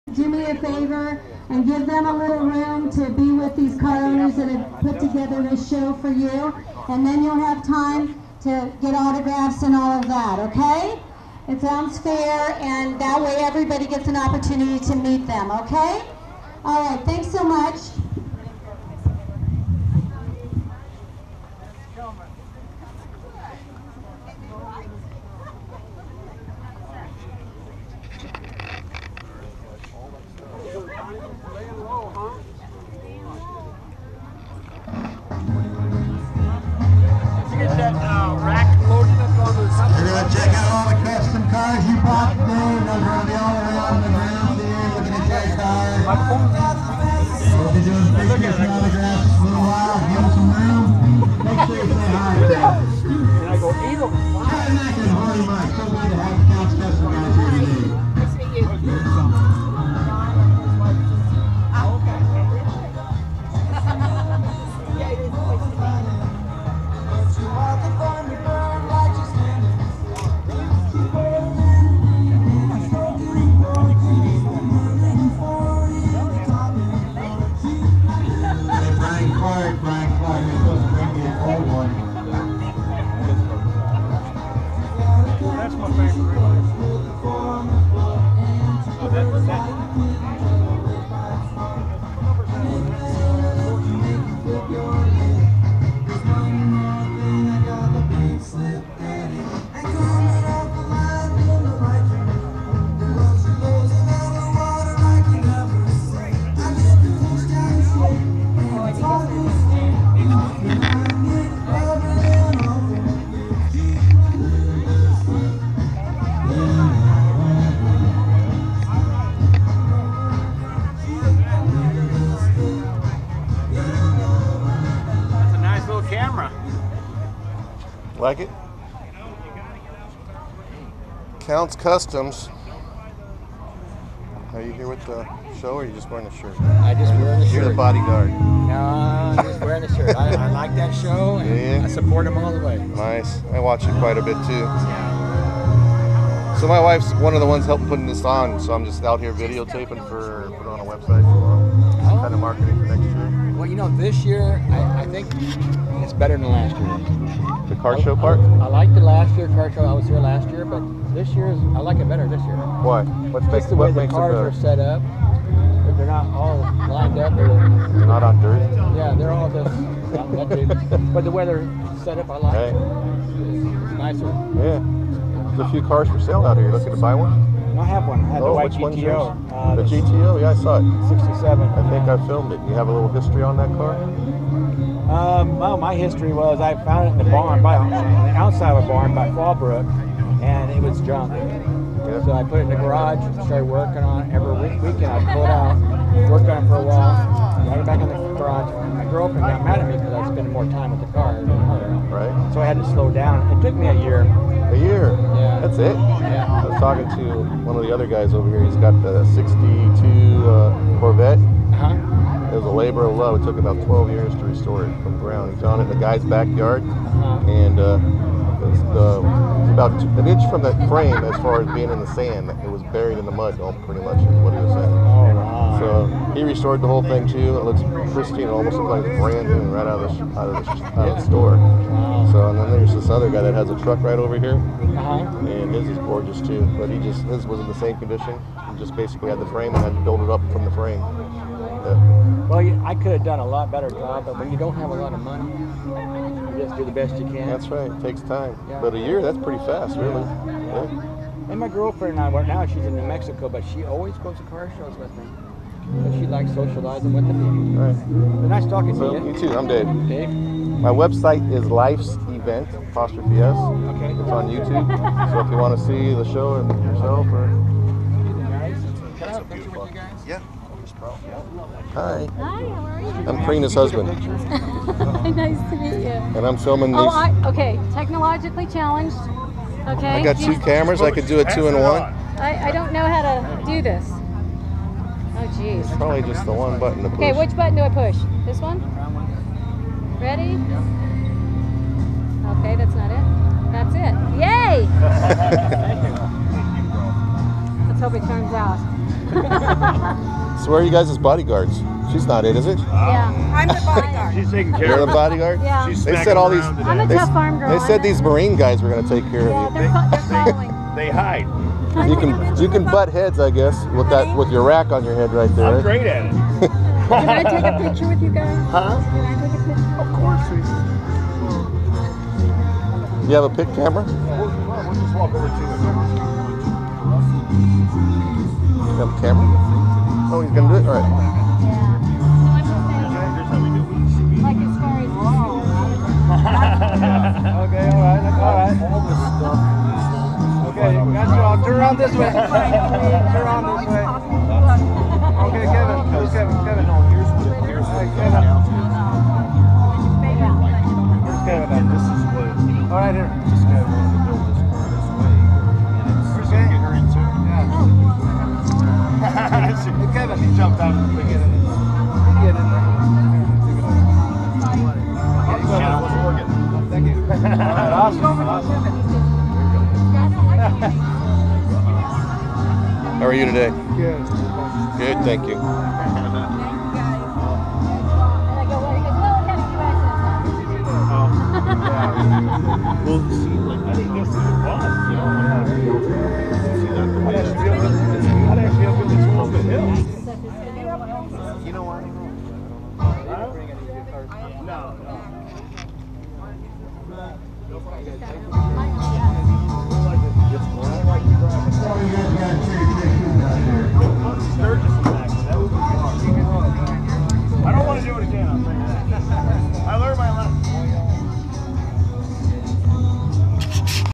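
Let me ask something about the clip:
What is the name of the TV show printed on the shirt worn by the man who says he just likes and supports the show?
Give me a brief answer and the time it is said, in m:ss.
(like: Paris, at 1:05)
Counts Kustoms, at 2:11.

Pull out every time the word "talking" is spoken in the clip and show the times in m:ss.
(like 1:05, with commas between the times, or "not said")
3:26, 4:18.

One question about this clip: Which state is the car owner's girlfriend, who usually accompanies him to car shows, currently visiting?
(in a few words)
New Mexico.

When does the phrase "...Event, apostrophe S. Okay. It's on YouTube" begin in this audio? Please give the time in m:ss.
4:22.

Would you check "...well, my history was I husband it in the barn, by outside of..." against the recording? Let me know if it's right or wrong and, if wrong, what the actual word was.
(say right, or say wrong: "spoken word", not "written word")
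wrong: "found", not "husband".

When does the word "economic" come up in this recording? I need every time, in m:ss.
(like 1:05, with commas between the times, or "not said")
not said.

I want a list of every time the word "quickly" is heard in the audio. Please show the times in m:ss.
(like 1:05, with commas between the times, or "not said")
not said.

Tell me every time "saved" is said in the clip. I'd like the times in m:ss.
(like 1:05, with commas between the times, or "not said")
not said.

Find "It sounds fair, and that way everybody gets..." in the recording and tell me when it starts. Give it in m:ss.
0:11.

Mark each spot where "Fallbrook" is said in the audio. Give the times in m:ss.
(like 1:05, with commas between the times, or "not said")
3:09.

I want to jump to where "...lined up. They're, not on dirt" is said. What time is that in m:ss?
2:46.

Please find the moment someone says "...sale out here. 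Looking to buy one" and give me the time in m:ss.
2:56.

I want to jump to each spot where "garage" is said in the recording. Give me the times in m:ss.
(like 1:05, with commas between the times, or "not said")
3:12, 3:18.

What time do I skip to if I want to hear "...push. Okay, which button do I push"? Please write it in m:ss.
4:47.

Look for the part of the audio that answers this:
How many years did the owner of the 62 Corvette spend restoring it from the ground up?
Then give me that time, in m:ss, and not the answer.
3:33.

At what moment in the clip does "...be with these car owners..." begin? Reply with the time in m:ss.
0:03.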